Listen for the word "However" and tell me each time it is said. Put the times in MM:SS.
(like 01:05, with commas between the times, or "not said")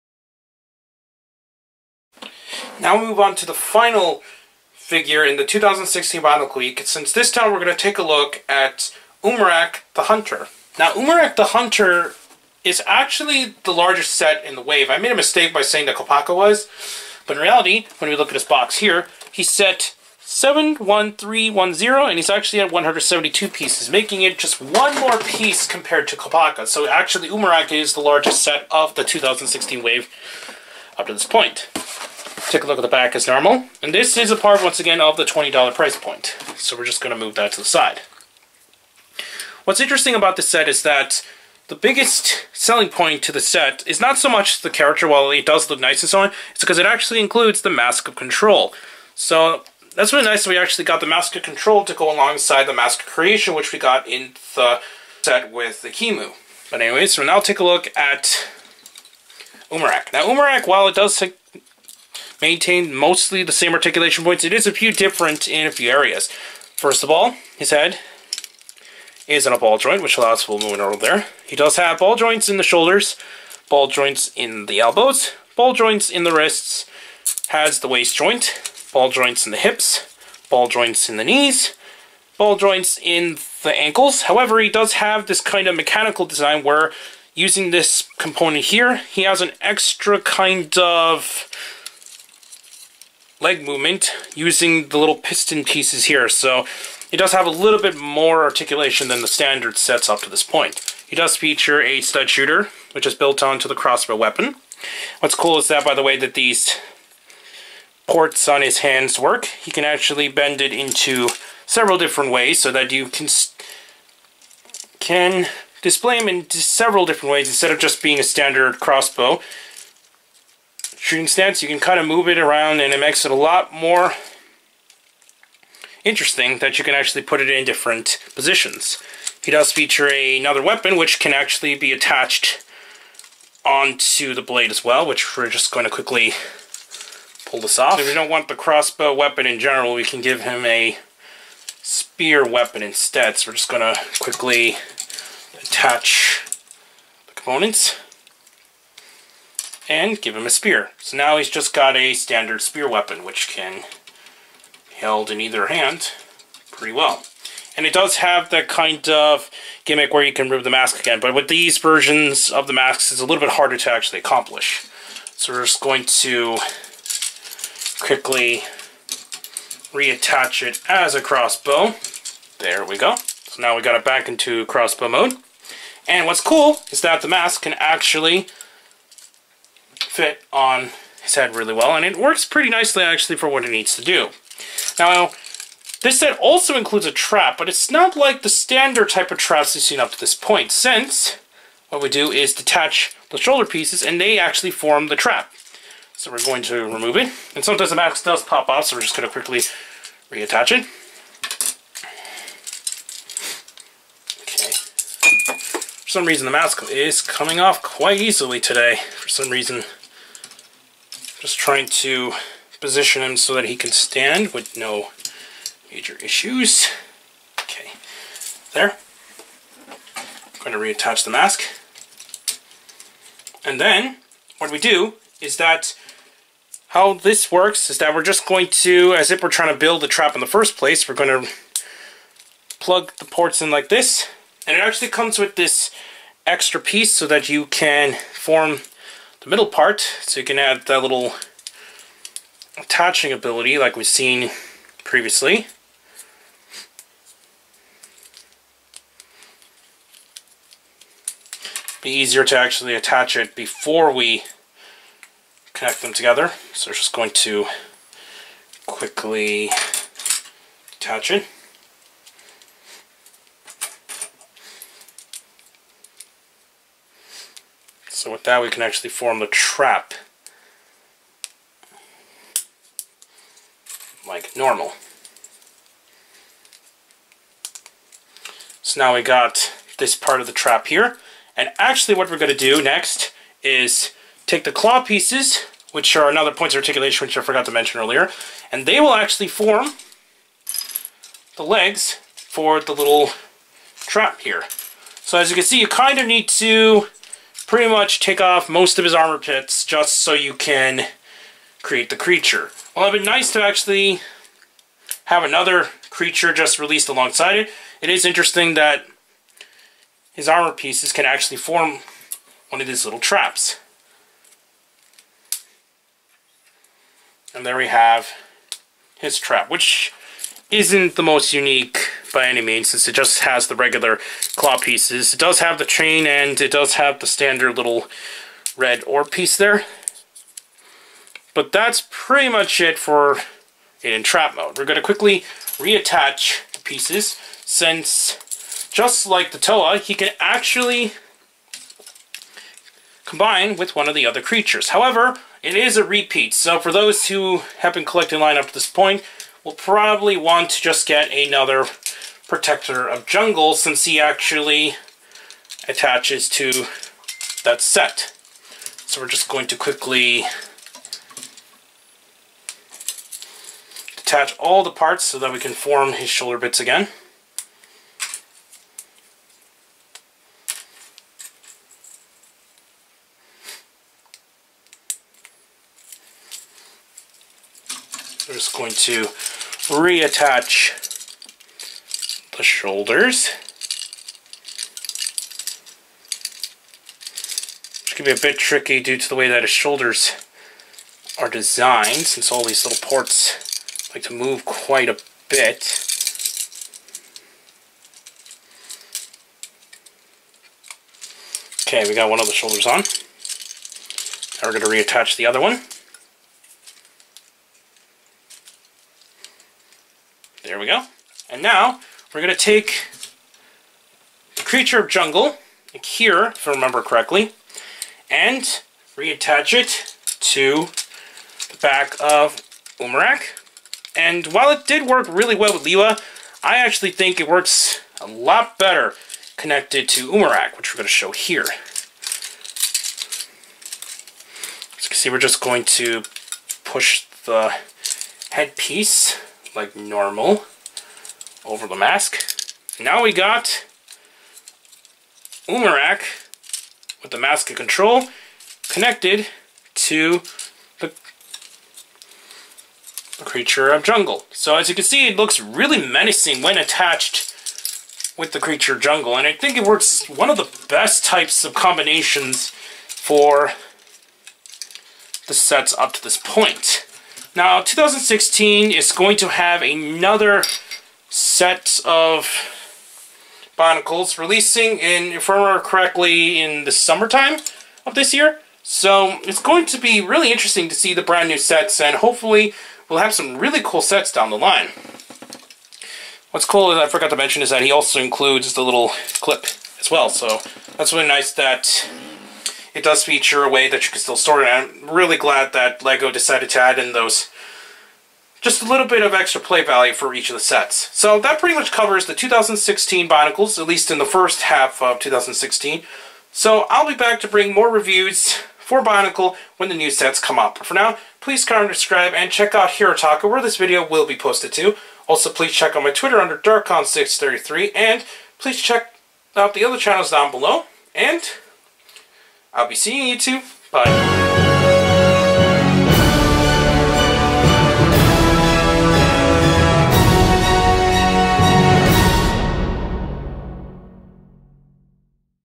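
01:24, 05:44.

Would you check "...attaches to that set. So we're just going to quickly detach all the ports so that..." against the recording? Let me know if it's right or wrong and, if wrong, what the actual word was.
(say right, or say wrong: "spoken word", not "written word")
wrong: "parts", not "ports".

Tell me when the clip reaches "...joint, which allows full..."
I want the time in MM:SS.
01:09.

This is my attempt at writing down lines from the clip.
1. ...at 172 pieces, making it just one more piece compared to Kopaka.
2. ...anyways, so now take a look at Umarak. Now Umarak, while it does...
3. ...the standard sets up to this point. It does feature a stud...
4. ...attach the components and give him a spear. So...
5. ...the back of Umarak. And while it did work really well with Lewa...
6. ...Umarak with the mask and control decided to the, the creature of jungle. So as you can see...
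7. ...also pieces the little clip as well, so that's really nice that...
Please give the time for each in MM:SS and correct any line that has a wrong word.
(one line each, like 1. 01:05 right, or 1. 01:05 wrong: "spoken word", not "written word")
1. 00:22 right
2. 00:56 right
3. 01:39 right
4. 02:25 right
5. 07:01 right
6. 07:25 wrong: "connected", not "decided"
7. 08:07 wrong: "includes", not "pieces".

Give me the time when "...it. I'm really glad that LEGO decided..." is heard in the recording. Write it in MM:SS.
08:14.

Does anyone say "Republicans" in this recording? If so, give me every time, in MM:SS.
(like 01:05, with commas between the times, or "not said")
not said.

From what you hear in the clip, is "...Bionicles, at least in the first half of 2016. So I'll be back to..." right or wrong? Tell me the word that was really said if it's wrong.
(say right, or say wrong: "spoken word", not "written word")
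right.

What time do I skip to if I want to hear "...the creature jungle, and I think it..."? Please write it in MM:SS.
07:38.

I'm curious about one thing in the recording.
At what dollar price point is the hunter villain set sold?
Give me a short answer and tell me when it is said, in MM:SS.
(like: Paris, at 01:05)
$20, at 00:35.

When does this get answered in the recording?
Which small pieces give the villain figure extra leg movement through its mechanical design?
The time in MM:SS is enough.
01:35.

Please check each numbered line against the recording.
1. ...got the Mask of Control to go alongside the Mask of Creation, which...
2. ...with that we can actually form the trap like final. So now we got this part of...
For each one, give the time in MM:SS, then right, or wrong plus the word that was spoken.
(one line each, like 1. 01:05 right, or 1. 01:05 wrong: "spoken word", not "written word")
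1. 00:50 right
2. 04:28 wrong: "normal", not "final".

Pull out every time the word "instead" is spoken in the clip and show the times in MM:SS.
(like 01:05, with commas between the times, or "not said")
01:57, 02:22.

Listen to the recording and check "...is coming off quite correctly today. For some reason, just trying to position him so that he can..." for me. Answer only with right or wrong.
wrong.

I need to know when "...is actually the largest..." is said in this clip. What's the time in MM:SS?
00:12.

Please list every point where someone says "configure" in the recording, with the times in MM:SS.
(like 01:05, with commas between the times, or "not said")
not said.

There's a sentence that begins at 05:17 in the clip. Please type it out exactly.
And there we have his trap, which isn't the most unique by any means since it just has the regular claw pieces.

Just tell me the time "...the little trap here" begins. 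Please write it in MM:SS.
04:52.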